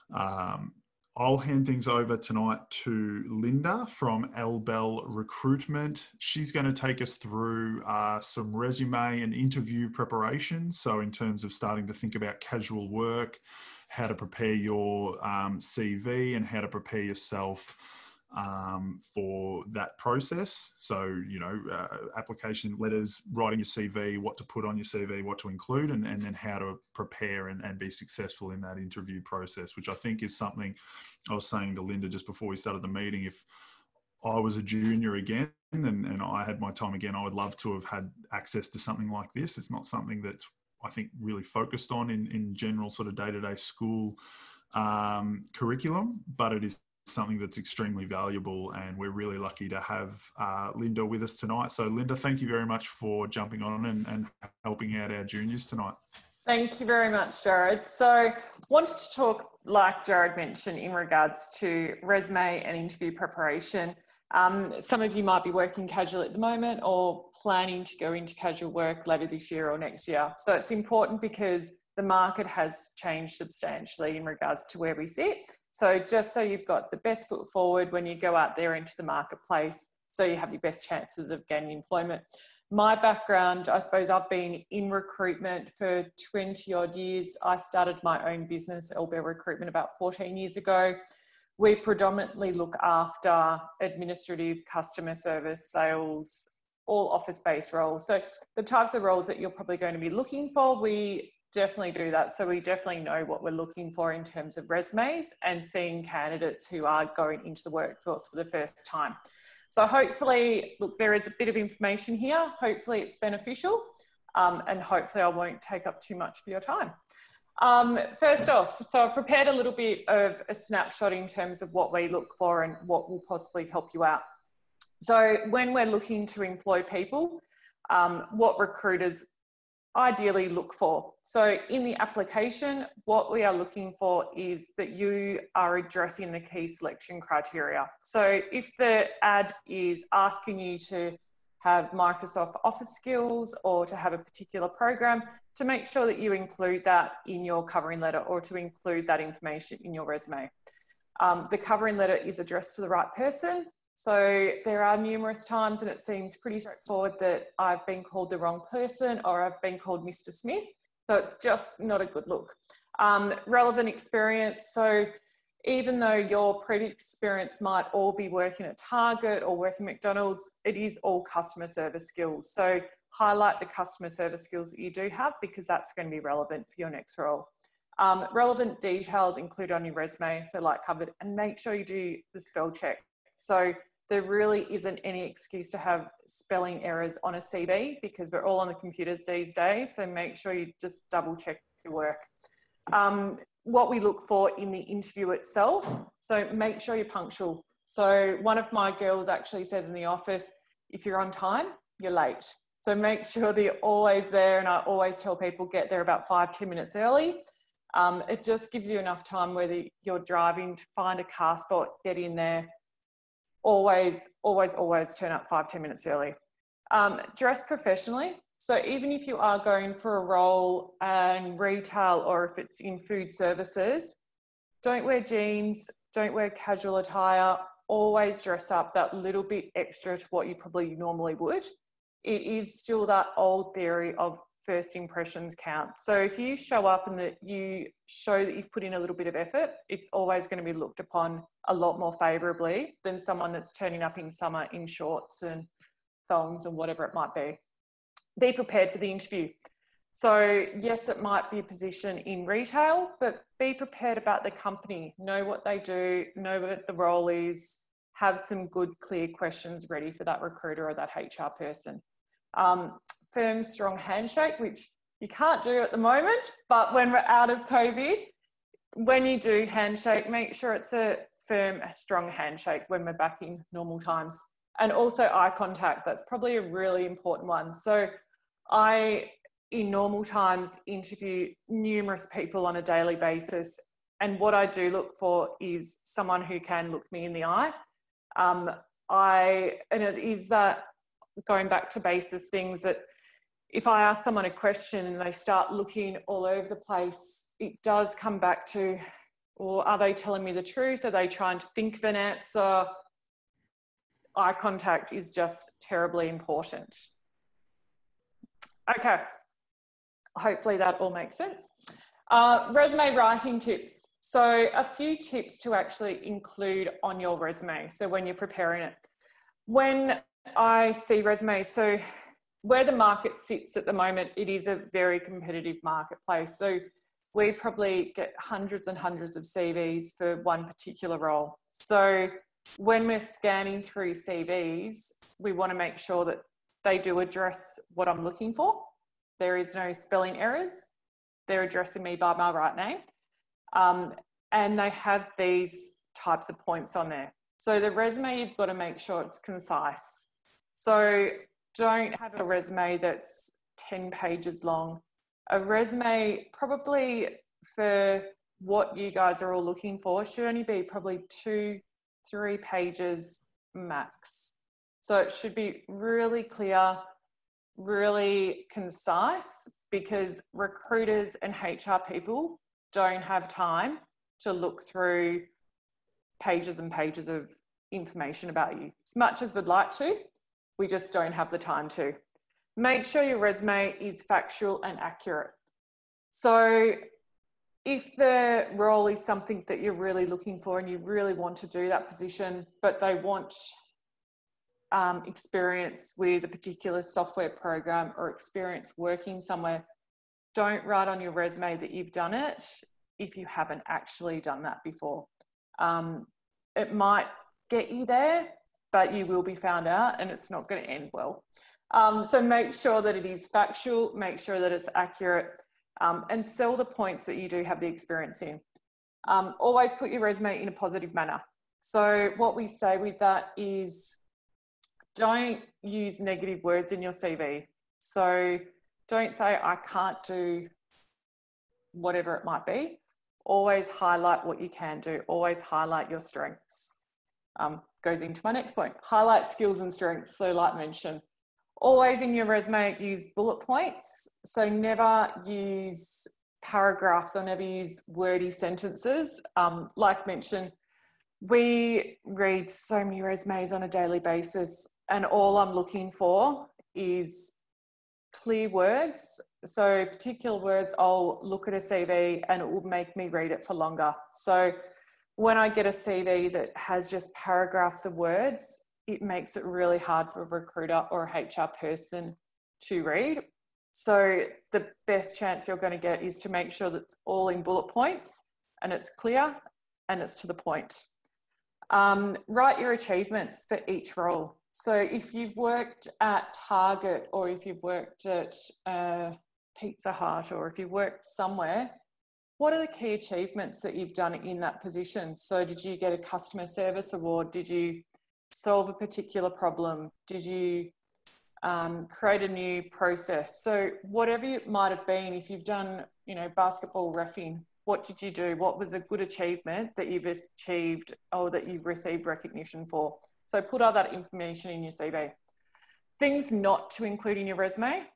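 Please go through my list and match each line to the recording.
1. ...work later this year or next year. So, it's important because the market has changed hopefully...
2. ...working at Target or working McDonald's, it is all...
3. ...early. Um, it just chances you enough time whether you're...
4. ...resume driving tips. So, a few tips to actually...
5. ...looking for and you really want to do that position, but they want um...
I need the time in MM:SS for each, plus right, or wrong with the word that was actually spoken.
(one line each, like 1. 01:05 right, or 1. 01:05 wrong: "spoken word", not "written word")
1. 01:08 wrong: "substantially", not "hopefully"
2. 02:48 right
3. 03:26 wrong: "gives", not "chances"
4. 05:12 wrong: "writing", not "driving"
5. 06:30 right.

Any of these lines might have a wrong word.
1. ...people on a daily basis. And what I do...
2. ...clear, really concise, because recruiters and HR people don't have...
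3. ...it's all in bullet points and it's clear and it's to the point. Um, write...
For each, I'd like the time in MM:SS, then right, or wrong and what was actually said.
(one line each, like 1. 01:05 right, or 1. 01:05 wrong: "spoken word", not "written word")
1. 04:42 right
2. 06:06 right
3. 07:57 right.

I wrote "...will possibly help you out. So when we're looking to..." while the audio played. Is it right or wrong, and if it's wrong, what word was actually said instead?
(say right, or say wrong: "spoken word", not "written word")
right.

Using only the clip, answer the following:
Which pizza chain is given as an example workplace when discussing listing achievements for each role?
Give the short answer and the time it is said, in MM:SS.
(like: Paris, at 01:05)
Pizza Hut, at 08:09.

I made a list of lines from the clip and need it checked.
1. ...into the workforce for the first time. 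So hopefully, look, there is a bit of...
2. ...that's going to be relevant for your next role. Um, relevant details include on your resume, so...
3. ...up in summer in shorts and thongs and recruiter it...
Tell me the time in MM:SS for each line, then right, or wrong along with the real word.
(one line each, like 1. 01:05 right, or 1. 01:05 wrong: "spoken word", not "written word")
1. 01:47 right
2. 02:55 right
3. 04:04 wrong: "whatever", not "recruiter".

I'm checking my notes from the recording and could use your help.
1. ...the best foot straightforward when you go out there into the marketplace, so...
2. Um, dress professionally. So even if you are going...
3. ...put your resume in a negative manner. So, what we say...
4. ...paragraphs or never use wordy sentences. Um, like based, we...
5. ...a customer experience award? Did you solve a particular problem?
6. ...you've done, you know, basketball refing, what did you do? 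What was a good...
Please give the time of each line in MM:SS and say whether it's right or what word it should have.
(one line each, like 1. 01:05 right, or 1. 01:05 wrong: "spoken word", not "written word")
1. 01:16 wrong: "forward", not "straightforward"
2. 03:36 right
3. 06:59 wrong: "positive", not "negative"
4. 07:26 wrong: "mentioned", not "based"
5. 08:16 wrong: "service", not "experience"
6. 08:25 right.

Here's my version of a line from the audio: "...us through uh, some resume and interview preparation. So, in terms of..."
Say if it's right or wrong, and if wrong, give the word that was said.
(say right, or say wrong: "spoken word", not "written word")
right.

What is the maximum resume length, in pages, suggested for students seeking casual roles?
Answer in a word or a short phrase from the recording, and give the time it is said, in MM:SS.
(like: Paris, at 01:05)
3, at 06:02.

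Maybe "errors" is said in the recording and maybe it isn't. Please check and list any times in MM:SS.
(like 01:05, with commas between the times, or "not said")
03:06, 05:40.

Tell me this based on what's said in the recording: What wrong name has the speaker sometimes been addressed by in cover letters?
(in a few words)
Mr. Smith.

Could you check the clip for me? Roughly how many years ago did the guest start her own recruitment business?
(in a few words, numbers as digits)
14.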